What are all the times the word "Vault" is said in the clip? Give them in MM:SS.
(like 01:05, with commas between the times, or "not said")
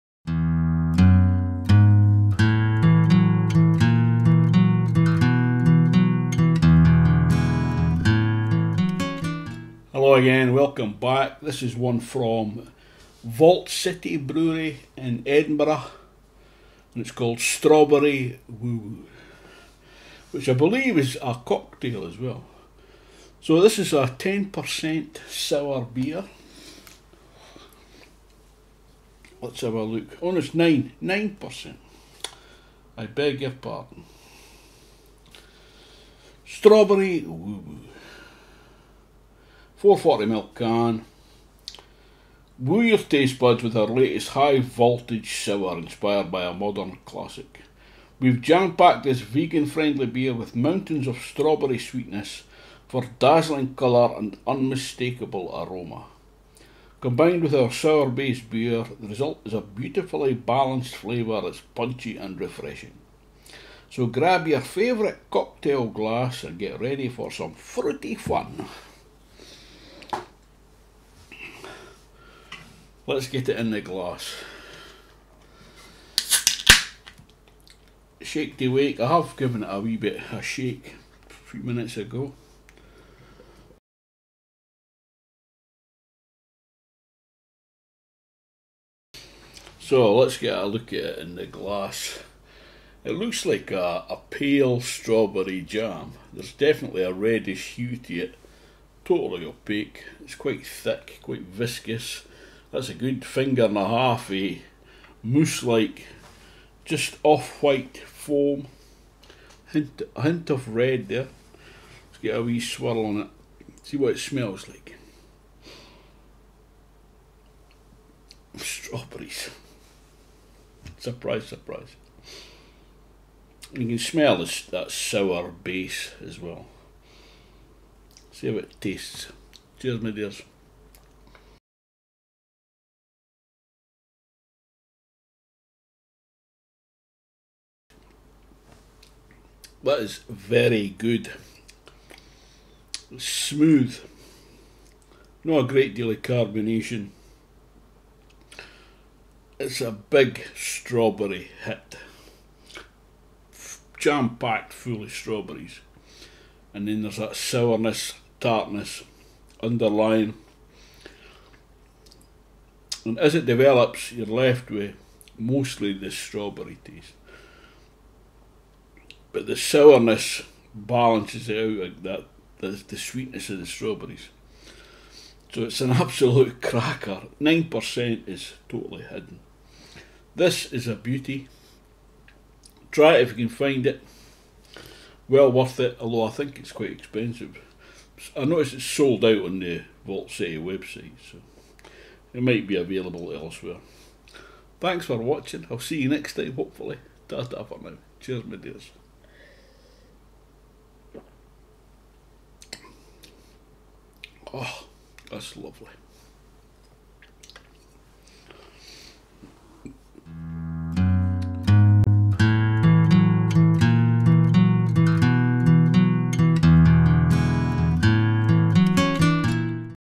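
00:13, 03:10.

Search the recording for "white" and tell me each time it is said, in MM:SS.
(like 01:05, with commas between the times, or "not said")
01:47.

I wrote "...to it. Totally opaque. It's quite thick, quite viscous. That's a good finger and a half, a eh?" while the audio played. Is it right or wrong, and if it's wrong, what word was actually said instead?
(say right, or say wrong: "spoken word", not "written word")
right.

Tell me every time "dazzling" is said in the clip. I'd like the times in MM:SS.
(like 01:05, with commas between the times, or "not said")
00:53.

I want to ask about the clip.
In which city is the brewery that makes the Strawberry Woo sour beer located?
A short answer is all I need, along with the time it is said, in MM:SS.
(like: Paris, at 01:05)
Edinburgh, at 00:15.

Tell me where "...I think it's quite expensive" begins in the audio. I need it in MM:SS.
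03:06.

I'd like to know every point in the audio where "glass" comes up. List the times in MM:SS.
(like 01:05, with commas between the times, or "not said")
01:05, 01:13, 01:31.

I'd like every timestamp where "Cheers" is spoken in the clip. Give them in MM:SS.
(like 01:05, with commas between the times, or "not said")
02:09, 03:18.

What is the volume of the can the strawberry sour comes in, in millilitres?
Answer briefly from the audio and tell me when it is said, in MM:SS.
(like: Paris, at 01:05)
440, at 00:39.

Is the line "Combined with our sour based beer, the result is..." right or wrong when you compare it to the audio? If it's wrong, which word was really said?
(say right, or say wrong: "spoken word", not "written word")
right.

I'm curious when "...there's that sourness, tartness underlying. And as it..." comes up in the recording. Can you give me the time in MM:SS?
02:37.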